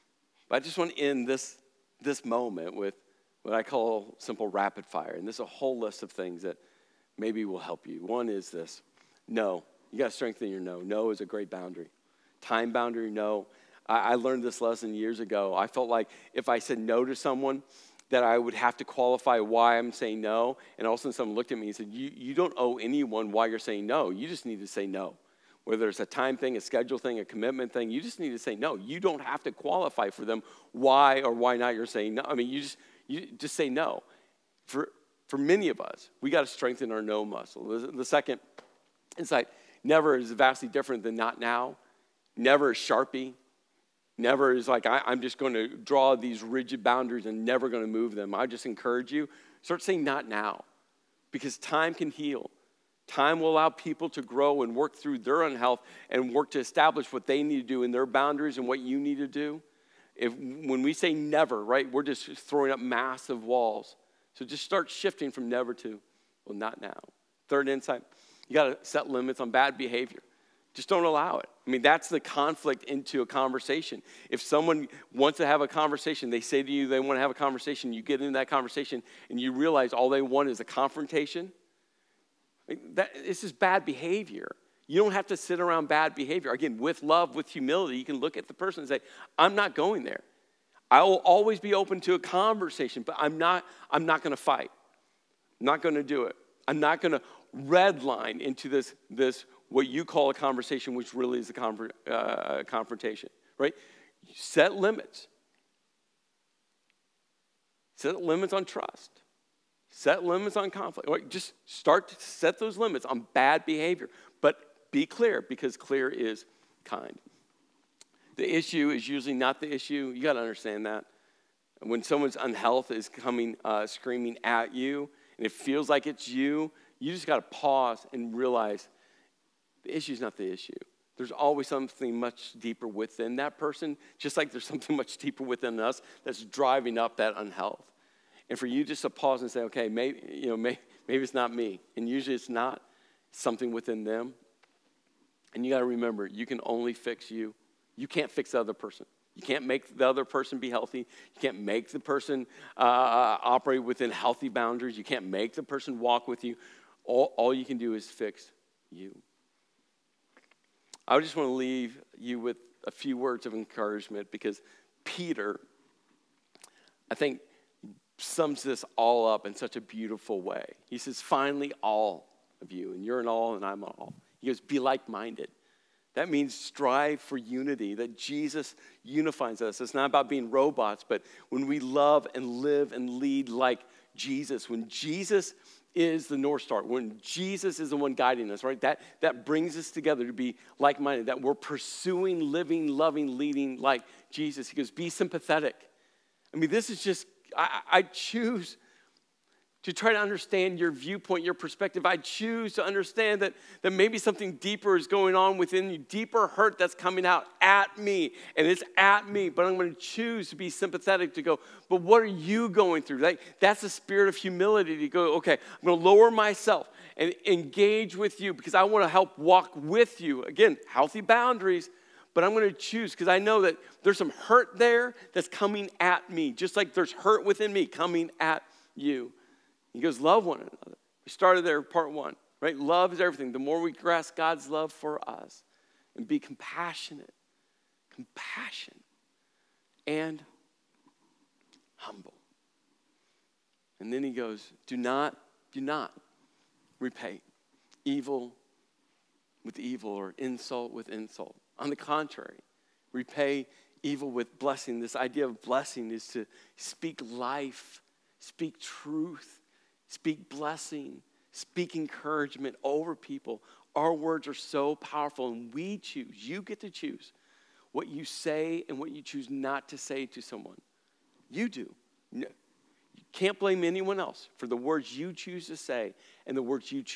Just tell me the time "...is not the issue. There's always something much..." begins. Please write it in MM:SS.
02:10.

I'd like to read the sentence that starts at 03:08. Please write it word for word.
That, that brings us together to be like minded, that we're pursuing, living, loving, leading like Jesus.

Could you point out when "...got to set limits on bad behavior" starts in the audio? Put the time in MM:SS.
01:08.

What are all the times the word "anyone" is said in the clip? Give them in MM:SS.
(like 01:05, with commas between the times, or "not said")
00:22, 04:33.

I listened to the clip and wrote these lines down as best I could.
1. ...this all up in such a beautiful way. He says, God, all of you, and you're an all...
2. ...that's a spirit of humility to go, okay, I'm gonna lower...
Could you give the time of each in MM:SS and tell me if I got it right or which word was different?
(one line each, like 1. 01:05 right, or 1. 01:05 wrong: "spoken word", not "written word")
1. 02:48 wrong: "Finally", not "God"
2. 03:33 right.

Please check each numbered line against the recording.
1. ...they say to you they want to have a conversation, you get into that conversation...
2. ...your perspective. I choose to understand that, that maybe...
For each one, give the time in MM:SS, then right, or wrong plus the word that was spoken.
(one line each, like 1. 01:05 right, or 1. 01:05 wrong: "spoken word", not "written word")
1. 01:16 right
2. 03:21 right.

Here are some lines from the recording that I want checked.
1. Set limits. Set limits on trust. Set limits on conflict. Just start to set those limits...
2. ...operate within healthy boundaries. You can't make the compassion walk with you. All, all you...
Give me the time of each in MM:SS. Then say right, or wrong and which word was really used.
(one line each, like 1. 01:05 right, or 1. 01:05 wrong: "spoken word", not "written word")
1. 01:44 right
2. 02:33 wrong: "person", not "compassion".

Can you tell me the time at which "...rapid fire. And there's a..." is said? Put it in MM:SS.
00:04.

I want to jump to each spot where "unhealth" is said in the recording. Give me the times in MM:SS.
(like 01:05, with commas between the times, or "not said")
00:55, 02:02, 02:17.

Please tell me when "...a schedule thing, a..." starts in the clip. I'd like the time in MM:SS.
00:26.